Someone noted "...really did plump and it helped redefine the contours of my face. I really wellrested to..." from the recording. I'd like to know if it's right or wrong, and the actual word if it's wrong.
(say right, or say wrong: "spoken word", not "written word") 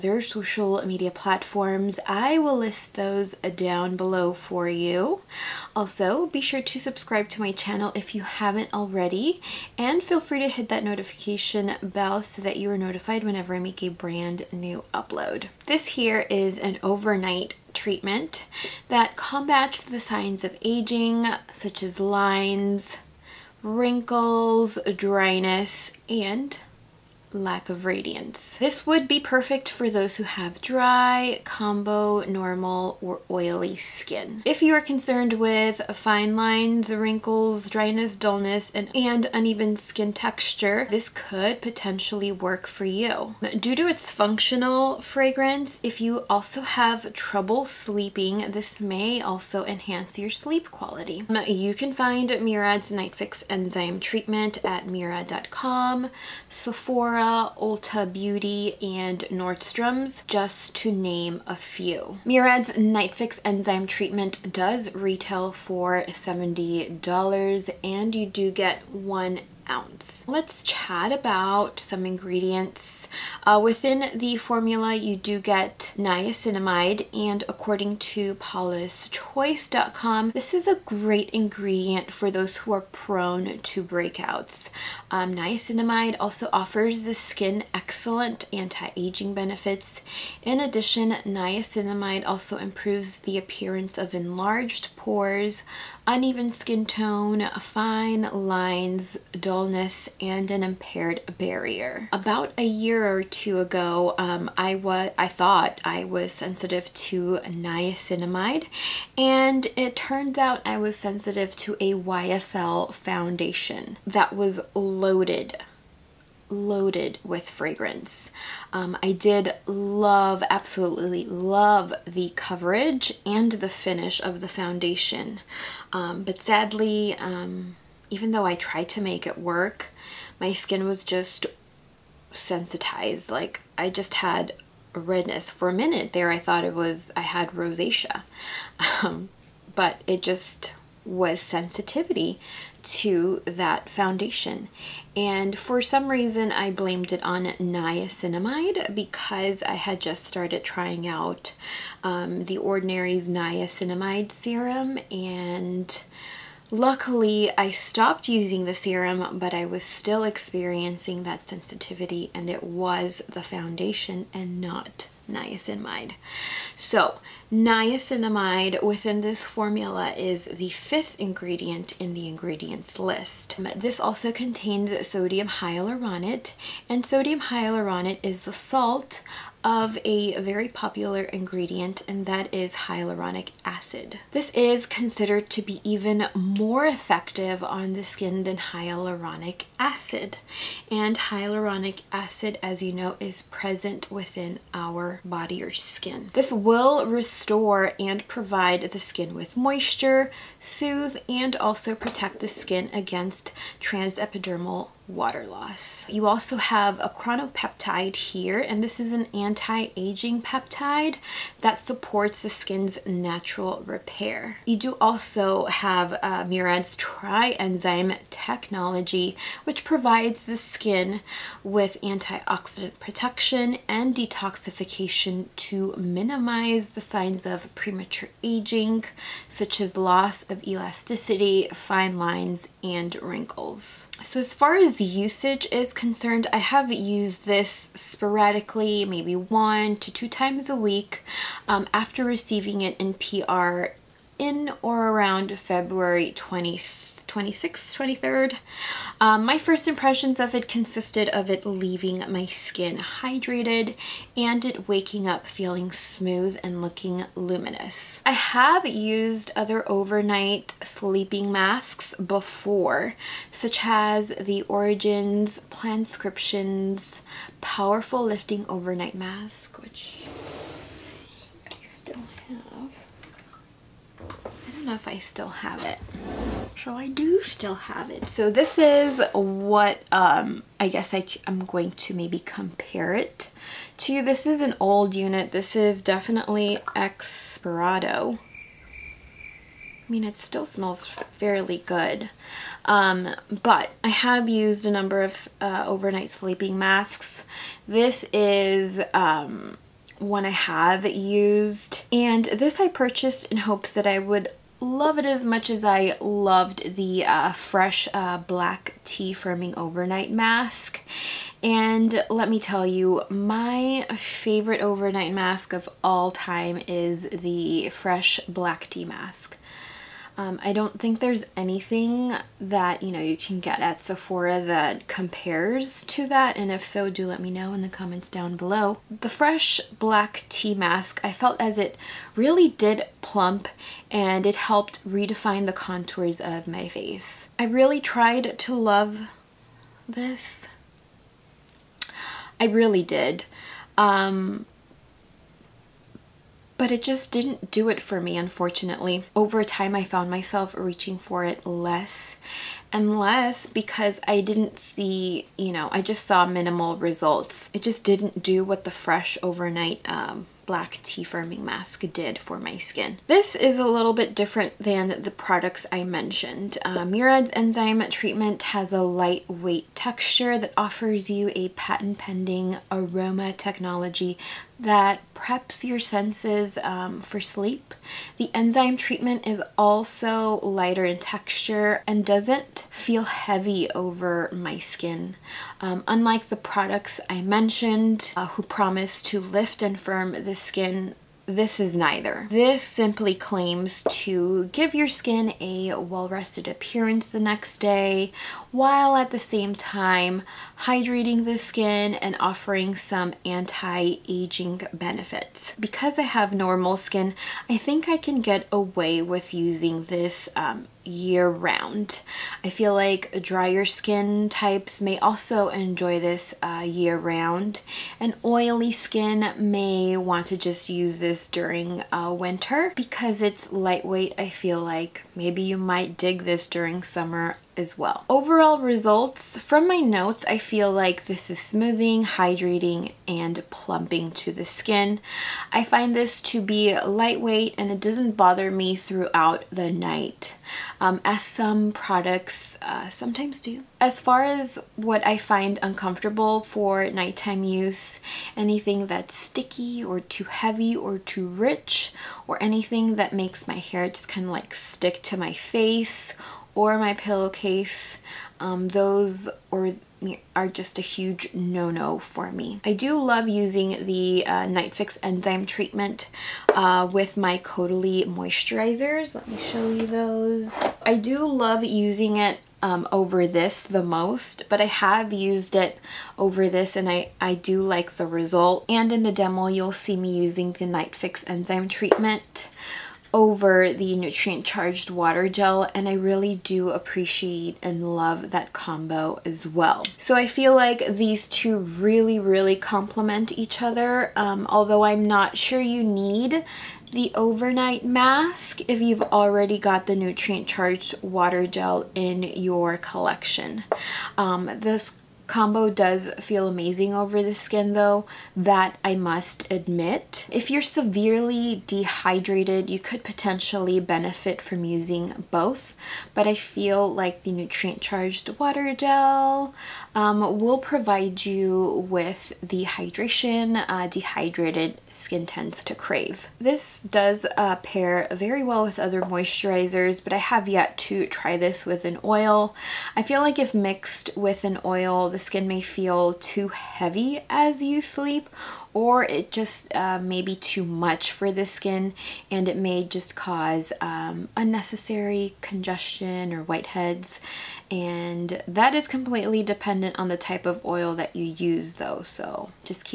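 wrong: "tried", not "wellrested".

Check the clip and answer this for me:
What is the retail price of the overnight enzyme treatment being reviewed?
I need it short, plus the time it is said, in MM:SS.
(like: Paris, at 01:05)
$70, at 01:06.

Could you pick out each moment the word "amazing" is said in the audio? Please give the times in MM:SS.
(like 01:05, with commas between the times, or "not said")
08:26.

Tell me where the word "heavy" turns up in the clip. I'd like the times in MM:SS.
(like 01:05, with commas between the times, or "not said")
06:23, 07:30, 08:56.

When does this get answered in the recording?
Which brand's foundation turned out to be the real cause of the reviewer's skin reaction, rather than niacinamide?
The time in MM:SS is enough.
01:51.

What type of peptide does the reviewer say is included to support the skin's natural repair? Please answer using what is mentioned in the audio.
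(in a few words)
chronopeptide.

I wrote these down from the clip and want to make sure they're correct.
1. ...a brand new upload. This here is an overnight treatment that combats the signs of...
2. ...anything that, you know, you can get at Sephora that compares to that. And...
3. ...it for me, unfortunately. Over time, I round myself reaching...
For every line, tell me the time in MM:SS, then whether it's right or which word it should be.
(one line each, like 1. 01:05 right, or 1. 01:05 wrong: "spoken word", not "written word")
1. 00:13 right
2. 05:21 right
3. 05:47 wrong: "found", not "round".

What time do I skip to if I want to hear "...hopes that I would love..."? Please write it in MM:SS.
05:03.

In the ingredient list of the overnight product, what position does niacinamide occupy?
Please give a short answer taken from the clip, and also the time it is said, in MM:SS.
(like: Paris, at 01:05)
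fifth, at 02:50.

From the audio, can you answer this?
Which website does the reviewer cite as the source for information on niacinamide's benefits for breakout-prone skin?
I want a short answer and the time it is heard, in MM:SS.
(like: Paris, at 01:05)
paulaschoice.com, at 01:18.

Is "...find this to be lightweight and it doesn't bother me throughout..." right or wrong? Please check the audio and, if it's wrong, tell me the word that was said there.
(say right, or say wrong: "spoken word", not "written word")
right.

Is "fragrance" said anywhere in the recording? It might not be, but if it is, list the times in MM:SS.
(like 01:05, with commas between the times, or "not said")
00:45, 01:57.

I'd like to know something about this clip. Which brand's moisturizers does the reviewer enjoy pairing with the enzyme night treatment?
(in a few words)
Caudalie.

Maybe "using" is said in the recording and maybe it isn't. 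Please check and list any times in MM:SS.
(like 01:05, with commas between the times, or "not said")
02:38, 06:49, 07:43, 07:51, 08:00, 08:34.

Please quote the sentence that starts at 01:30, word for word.
In addition, niacinamide also improves the appearance of enlarged pores, uneven skin tone, fine lines, dullness, and an impaired barrier.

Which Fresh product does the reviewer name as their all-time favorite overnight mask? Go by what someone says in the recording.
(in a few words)
black tea firming overnight mask.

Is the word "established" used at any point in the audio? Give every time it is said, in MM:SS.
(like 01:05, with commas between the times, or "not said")
not said.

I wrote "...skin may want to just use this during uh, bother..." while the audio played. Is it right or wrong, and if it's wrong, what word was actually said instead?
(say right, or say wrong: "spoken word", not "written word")
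wrong: "winter", not "bother".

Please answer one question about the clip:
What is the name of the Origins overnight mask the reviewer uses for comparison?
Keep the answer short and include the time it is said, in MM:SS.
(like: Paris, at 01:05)
Plantscriptions Powerful Lifting Overnight Mask, at 04:25.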